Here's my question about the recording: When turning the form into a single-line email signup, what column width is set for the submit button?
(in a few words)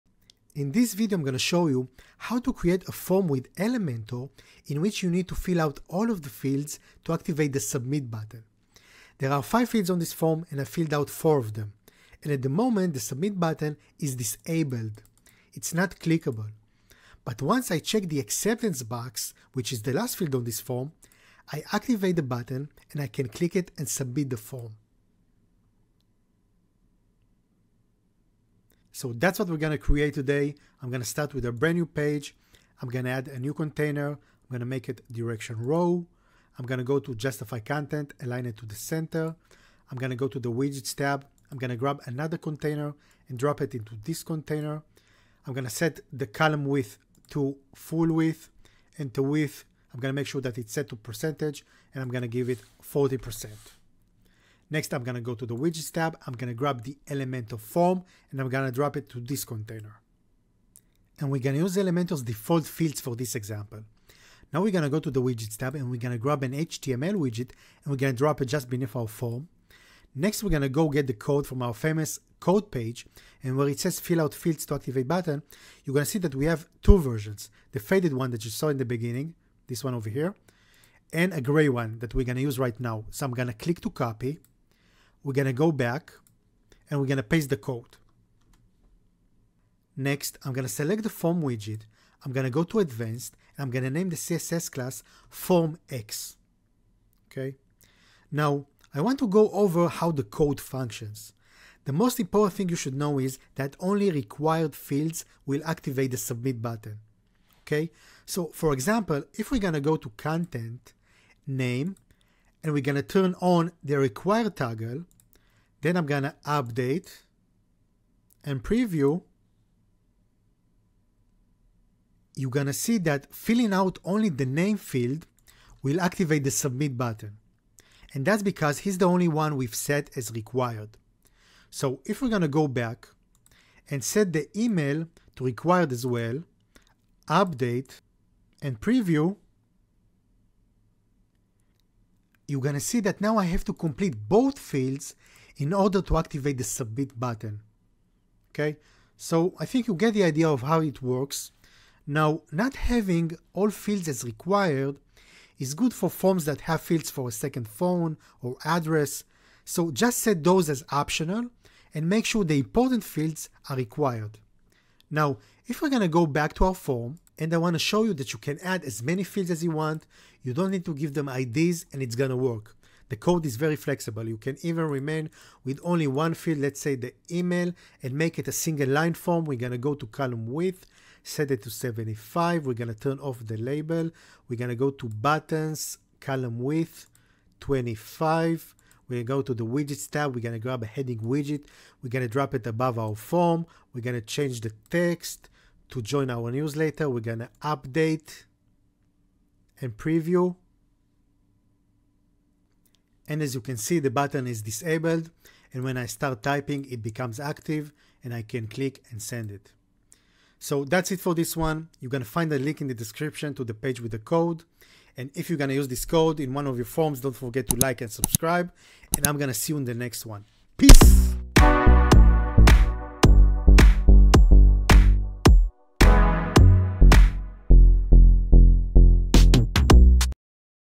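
25.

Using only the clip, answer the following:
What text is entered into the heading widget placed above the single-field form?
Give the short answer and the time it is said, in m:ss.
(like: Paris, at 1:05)
join our newsletter, at 3:16.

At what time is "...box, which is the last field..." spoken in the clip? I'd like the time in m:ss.
0:18.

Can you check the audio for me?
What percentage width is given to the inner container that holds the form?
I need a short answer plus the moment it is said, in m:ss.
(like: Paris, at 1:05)
40%, at 0:52.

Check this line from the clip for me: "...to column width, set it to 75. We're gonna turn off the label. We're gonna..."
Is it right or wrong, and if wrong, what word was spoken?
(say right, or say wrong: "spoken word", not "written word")
right.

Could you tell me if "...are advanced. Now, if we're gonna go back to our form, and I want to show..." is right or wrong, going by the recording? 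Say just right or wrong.
wrong.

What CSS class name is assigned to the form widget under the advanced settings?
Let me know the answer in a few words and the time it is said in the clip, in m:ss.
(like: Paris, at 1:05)
formX, at 1:35.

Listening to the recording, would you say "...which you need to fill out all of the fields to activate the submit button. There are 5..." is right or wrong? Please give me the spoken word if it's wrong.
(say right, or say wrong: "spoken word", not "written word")
right.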